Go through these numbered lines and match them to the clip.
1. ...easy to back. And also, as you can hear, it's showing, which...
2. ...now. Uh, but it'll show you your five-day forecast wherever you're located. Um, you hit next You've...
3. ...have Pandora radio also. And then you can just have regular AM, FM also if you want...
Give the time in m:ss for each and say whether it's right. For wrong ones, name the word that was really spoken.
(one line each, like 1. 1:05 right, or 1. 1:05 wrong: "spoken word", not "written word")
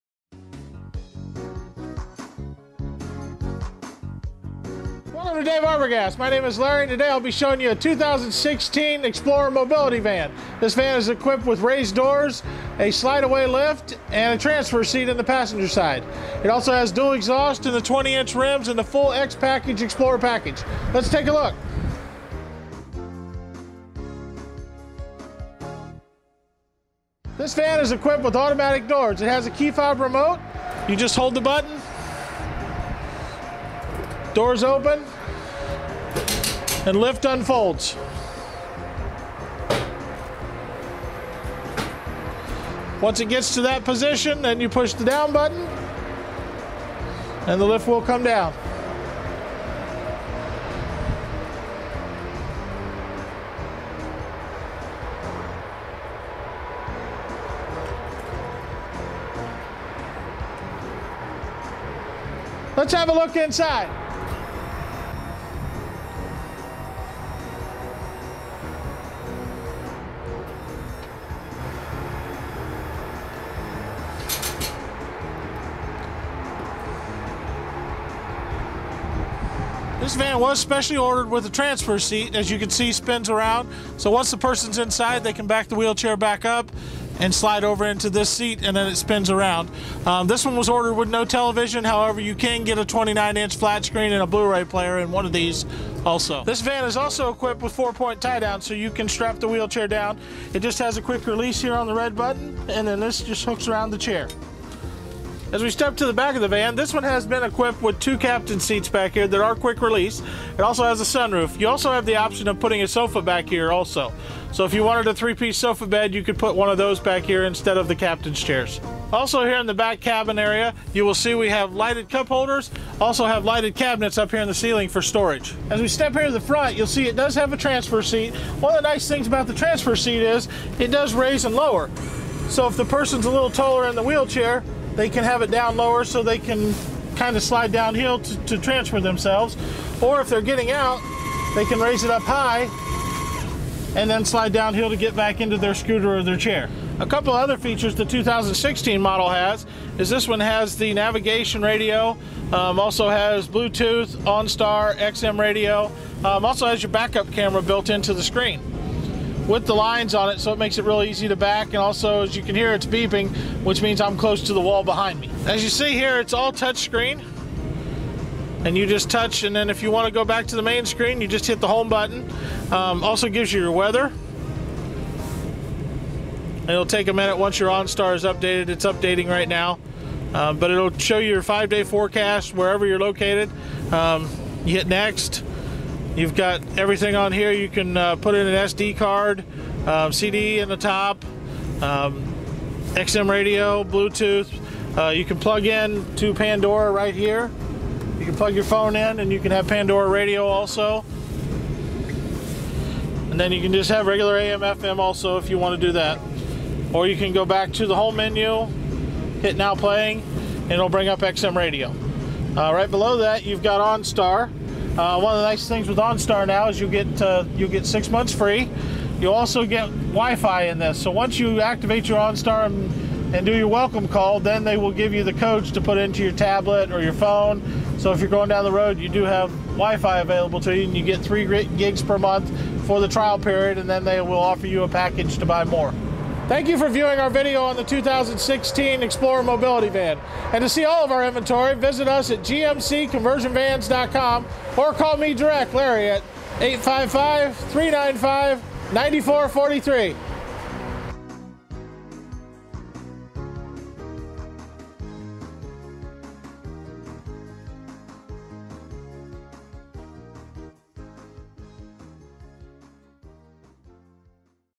1. 2:41 wrong: "beeping", not "showing"
2. 2:59 right
3. 3:19 right.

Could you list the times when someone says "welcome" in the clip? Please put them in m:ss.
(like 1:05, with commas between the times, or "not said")
0:05, 3:43.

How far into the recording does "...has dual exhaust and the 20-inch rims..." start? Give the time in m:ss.
0:16.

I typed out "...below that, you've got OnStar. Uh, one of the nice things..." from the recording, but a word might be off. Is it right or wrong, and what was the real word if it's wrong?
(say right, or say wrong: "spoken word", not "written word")
right.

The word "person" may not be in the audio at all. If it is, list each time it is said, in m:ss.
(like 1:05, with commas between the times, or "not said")
1:24, 2:12.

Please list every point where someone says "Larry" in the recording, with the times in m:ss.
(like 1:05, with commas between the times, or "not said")
0:06, 4:05.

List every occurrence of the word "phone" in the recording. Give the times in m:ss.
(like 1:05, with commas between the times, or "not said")
3:18, 3:47.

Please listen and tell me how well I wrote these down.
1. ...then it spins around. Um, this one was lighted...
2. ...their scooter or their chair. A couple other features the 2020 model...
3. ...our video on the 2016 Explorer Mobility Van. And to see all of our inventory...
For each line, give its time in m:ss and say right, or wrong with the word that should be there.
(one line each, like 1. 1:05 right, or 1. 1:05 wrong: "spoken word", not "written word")
1. 1:28 wrong: "ordered", not "lighted"
2. 2:25 wrong: "2016", not "2020"
3. 3:57 right.